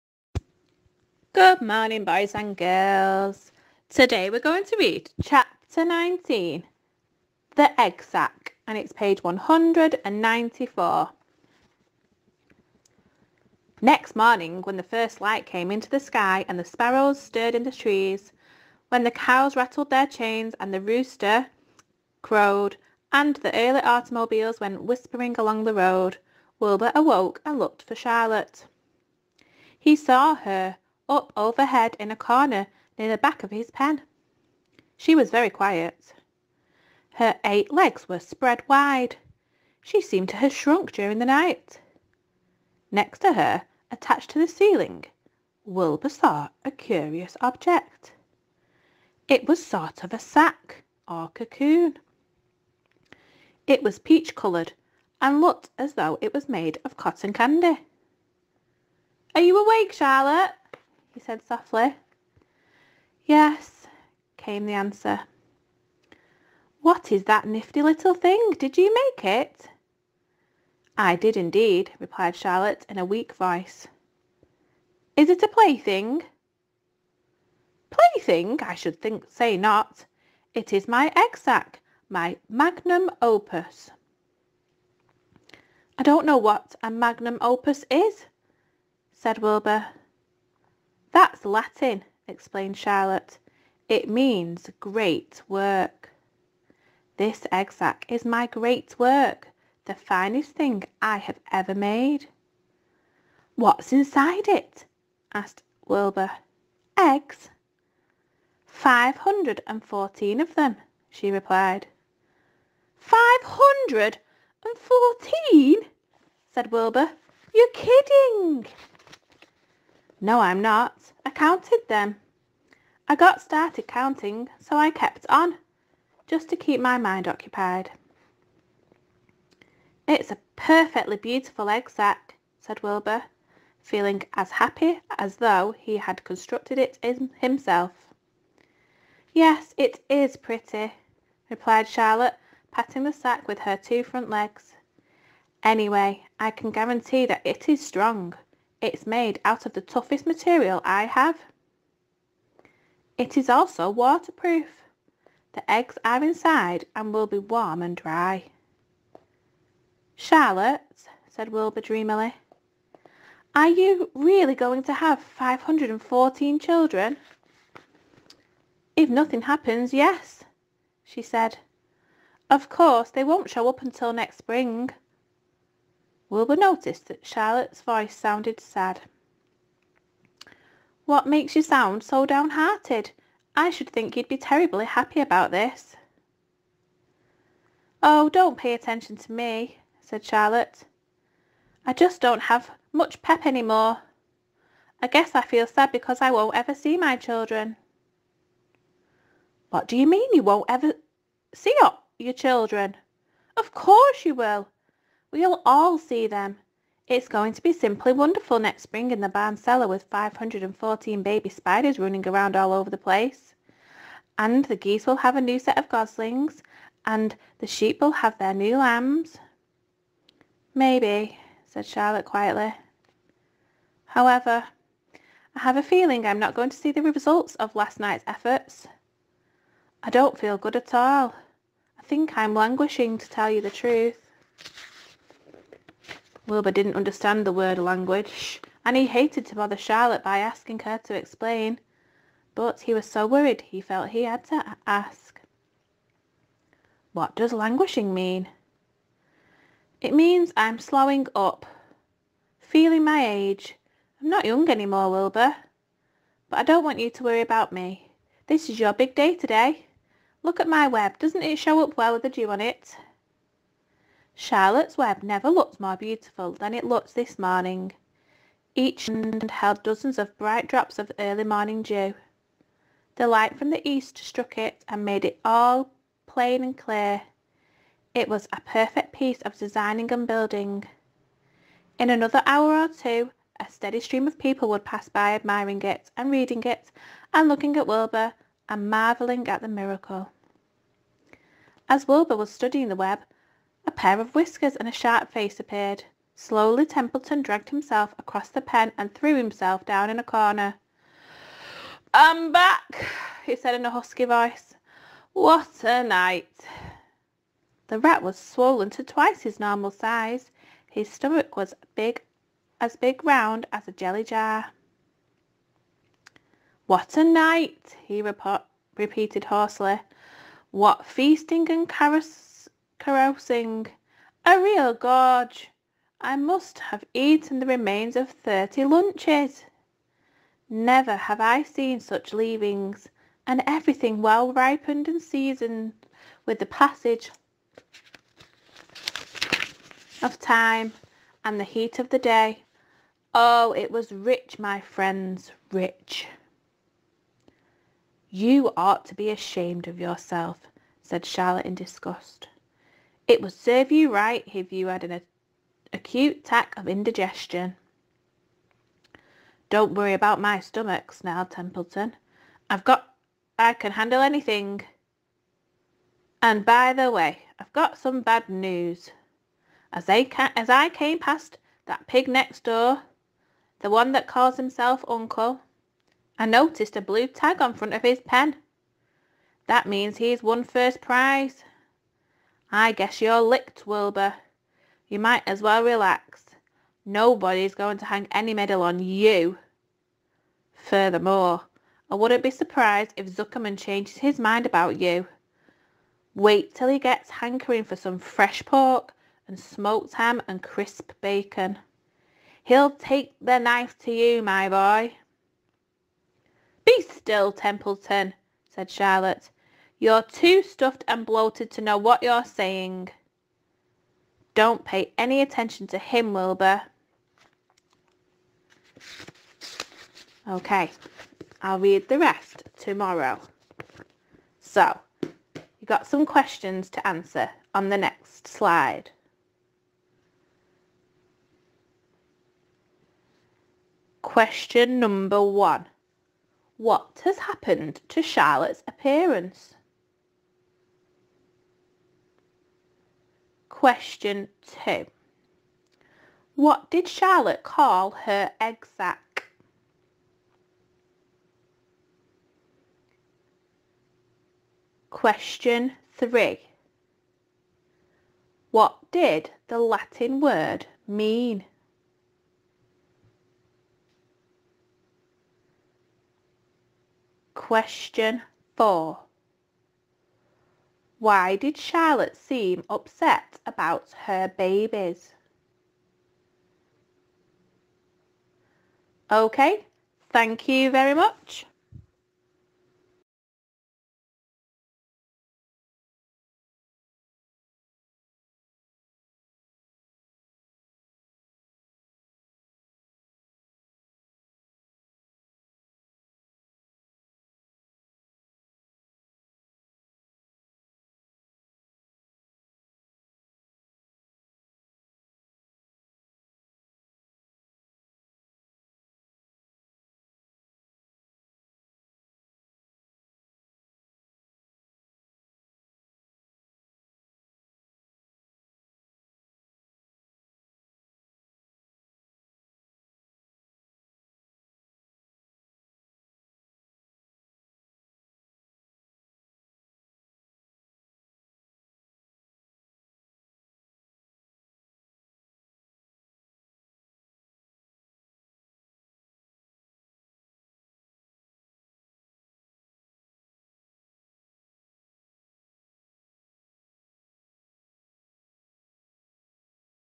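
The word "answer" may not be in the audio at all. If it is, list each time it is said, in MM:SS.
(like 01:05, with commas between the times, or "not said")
01:04, 07:07.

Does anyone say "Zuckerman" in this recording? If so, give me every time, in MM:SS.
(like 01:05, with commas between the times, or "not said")
06:33.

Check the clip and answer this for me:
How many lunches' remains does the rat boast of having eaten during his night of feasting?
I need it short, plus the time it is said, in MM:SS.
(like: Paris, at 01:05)
30, at 05:28.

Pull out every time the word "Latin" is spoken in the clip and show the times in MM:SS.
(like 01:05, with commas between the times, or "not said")
01:31, 07:39.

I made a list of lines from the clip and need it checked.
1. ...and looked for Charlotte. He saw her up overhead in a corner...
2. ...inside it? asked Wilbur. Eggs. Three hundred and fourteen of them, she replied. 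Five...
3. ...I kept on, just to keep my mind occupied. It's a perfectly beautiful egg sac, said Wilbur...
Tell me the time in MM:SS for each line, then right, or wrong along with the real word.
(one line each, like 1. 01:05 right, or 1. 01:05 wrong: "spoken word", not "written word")
1. 00:27 right
2. 01:43 wrong: "Five", not "Three"
3. 02:04 right.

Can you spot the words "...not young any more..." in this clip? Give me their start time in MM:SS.
04:14.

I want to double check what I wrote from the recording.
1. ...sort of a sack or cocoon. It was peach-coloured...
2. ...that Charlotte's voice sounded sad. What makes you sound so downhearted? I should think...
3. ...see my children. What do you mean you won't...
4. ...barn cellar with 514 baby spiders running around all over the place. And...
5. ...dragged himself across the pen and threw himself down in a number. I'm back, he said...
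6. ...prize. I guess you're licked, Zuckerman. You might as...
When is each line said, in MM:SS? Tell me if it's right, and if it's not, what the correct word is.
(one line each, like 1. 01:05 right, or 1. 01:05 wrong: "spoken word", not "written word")
1. 00:49 right
2. 02:57 right
3. 03:16 right
4. 03:29 right
5. 04:57 wrong: "corner", not "number"
6. 06:21 wrong: "Wilbur", not "Zuckerman".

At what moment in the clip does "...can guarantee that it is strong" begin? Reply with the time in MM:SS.
02:26.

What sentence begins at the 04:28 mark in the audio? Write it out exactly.
Each end held dozens of bright drops of early morning dew.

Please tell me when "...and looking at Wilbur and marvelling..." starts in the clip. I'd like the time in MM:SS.
04:47.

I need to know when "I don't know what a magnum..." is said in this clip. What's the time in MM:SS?
01:25.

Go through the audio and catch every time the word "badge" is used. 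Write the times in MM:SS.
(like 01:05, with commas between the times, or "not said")
not said.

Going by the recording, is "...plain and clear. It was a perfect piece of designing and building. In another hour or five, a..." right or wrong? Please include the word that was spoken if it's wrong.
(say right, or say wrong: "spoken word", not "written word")
wrong: "two", not "five".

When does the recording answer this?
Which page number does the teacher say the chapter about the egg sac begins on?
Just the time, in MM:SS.
00:08.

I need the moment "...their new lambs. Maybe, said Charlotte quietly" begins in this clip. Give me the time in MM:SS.
03:38.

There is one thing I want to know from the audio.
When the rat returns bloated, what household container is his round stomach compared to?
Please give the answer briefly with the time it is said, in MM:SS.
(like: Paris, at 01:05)
A jelly jar, at 05:13.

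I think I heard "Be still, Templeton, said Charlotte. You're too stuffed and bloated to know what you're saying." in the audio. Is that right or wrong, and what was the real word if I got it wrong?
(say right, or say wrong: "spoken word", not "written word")
right.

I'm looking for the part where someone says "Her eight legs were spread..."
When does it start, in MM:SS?
00:37.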